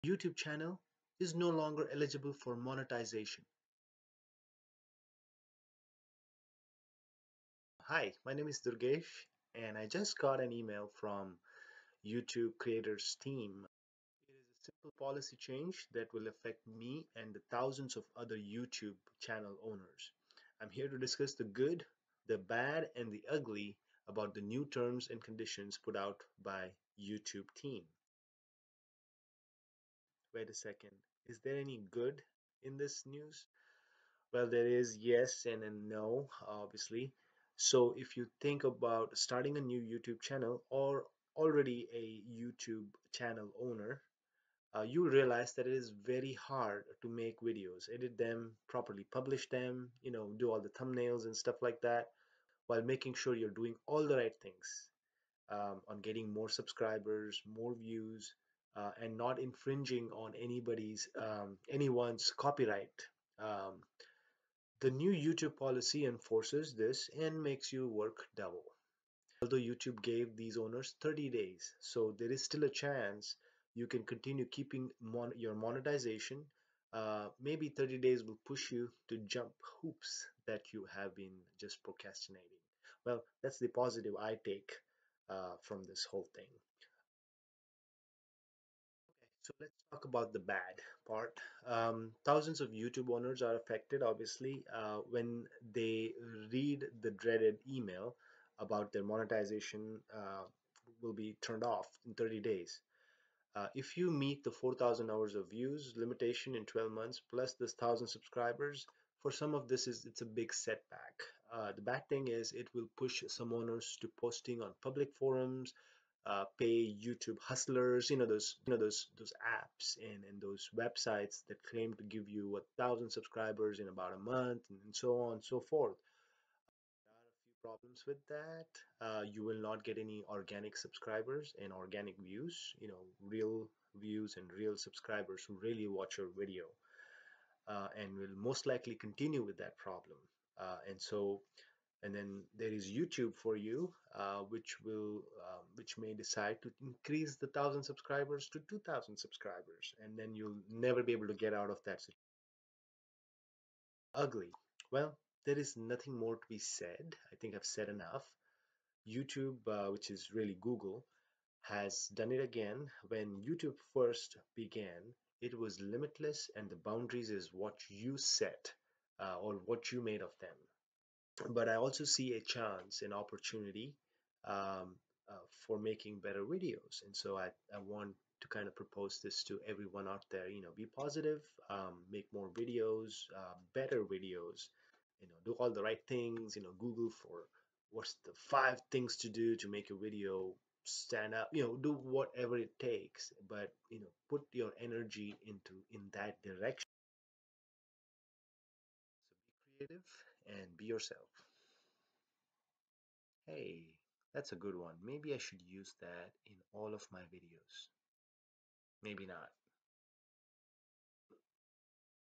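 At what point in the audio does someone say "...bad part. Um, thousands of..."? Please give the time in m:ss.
1:30.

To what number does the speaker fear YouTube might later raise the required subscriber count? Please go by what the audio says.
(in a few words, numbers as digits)
2,000.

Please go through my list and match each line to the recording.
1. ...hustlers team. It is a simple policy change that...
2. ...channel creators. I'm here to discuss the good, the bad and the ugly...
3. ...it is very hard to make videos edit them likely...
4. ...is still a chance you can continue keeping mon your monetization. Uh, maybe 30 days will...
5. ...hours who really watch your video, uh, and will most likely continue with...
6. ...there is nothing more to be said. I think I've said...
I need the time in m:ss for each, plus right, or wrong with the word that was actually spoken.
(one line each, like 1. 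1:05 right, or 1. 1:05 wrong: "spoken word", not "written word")
1. 0:12 wrong: "creators", not "hustlers"
2. 0:19 wrong: "owners", not "creators"
3. 0:45 wrong: "properly", not "likely"
4. 1:12 right
5. 2:14 wrong: "subscribers", not "hours"
6. 2:35 right.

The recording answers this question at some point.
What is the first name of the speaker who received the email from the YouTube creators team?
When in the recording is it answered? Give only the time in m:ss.
0:08.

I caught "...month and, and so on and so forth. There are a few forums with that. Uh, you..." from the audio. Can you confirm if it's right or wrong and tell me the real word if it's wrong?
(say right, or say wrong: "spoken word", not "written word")
wrong: "problems", not "forums".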